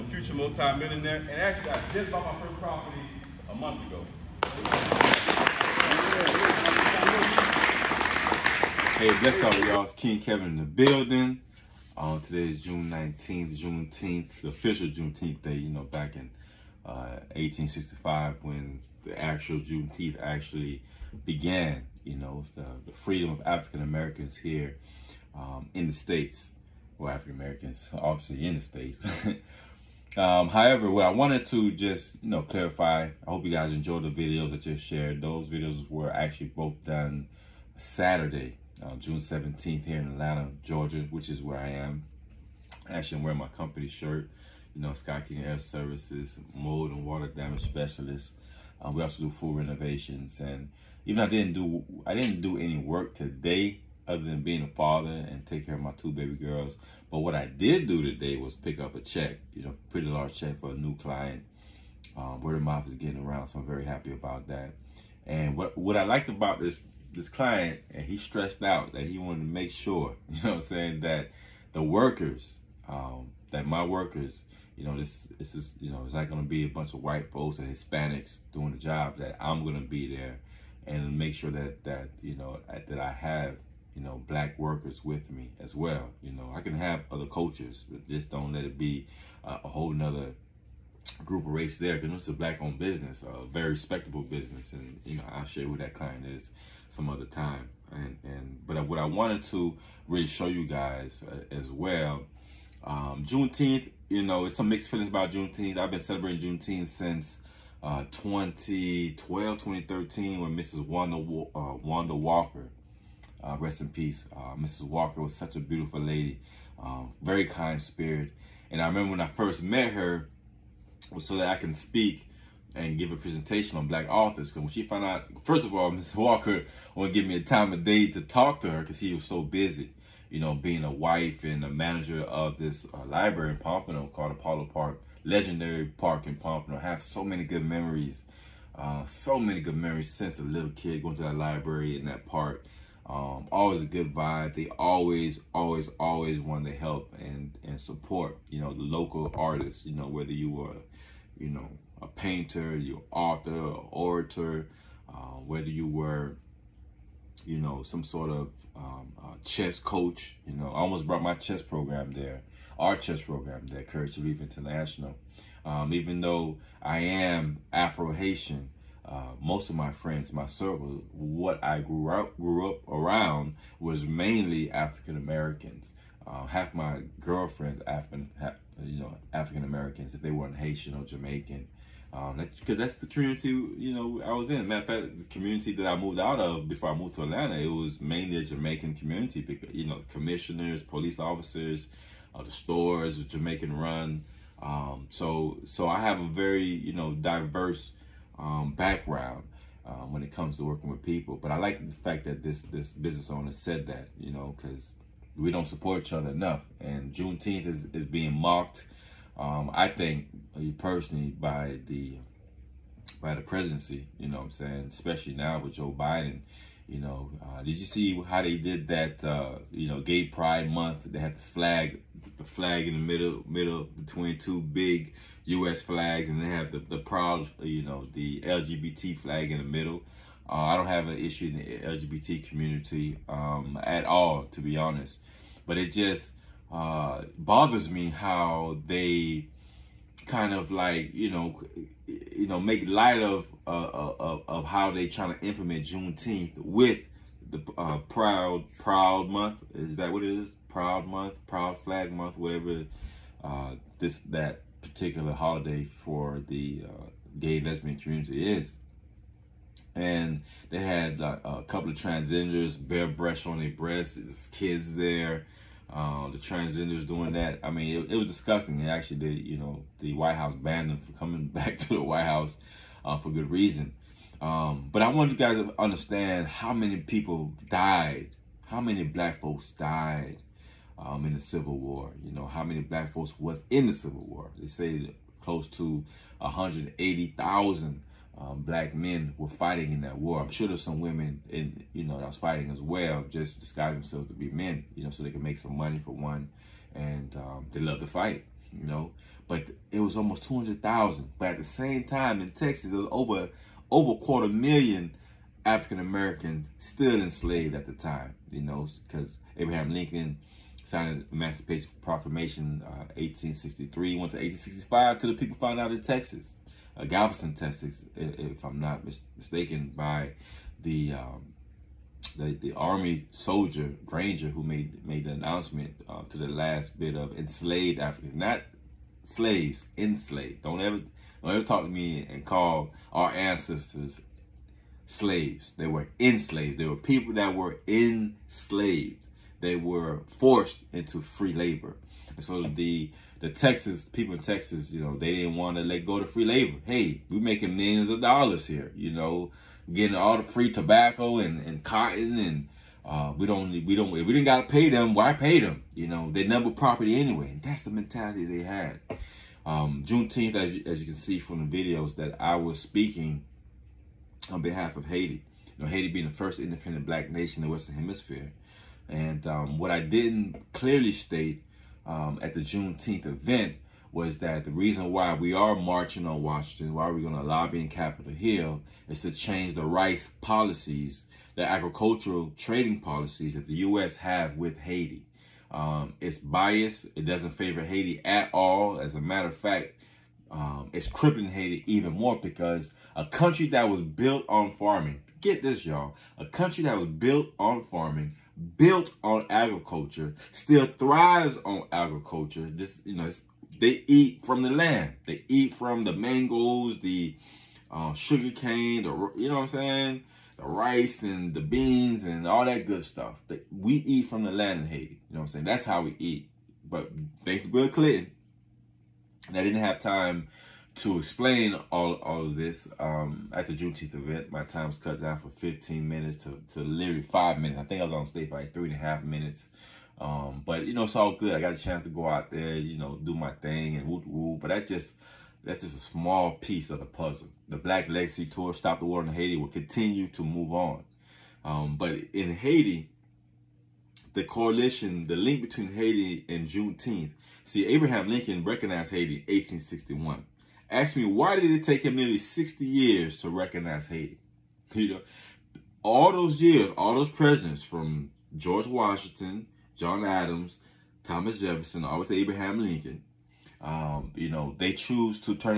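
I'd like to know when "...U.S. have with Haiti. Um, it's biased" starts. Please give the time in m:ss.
6:23.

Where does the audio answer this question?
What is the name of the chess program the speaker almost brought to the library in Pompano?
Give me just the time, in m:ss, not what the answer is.
2:43.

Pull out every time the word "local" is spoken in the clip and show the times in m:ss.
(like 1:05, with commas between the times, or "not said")
2:28.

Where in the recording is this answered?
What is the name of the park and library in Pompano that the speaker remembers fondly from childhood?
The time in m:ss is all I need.
2:14.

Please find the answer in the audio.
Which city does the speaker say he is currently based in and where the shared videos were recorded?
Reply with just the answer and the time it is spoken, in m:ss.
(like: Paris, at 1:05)
Atlanta, Georgia, at 0:40.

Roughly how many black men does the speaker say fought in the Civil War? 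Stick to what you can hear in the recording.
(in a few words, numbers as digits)
180,000.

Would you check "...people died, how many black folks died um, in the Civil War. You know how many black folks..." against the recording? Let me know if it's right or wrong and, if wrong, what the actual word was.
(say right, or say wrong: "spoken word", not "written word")
right.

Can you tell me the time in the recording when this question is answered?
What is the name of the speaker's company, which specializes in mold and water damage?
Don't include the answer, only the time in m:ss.
0:44.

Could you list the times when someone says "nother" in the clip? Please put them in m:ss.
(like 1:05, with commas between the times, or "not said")
1:29.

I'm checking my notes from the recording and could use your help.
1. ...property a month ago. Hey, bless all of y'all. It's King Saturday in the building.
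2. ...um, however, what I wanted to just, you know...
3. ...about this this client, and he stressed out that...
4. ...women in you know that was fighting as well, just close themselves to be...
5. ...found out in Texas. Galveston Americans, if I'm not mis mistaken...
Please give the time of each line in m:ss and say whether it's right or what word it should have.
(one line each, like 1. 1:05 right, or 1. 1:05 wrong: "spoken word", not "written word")
1. 0:02 wrong: "Kevin", not "Saturday"
2. 0:30 right
3. 1:06 right
4. 4:50 wrong: "disguise", not "close"
5. 5:15 wrong: "Texas", not "Americans".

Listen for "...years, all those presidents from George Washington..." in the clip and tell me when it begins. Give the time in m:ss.
7:36.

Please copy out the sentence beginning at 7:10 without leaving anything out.
Um, but, you know, it's all good.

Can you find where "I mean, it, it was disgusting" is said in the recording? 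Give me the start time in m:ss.
4:27.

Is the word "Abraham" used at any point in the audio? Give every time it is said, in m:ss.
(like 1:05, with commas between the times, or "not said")
5:09, 7:27, 7:42.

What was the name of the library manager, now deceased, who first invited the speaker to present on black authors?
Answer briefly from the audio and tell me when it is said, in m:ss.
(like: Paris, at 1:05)
Wanda Walker, at 1:51.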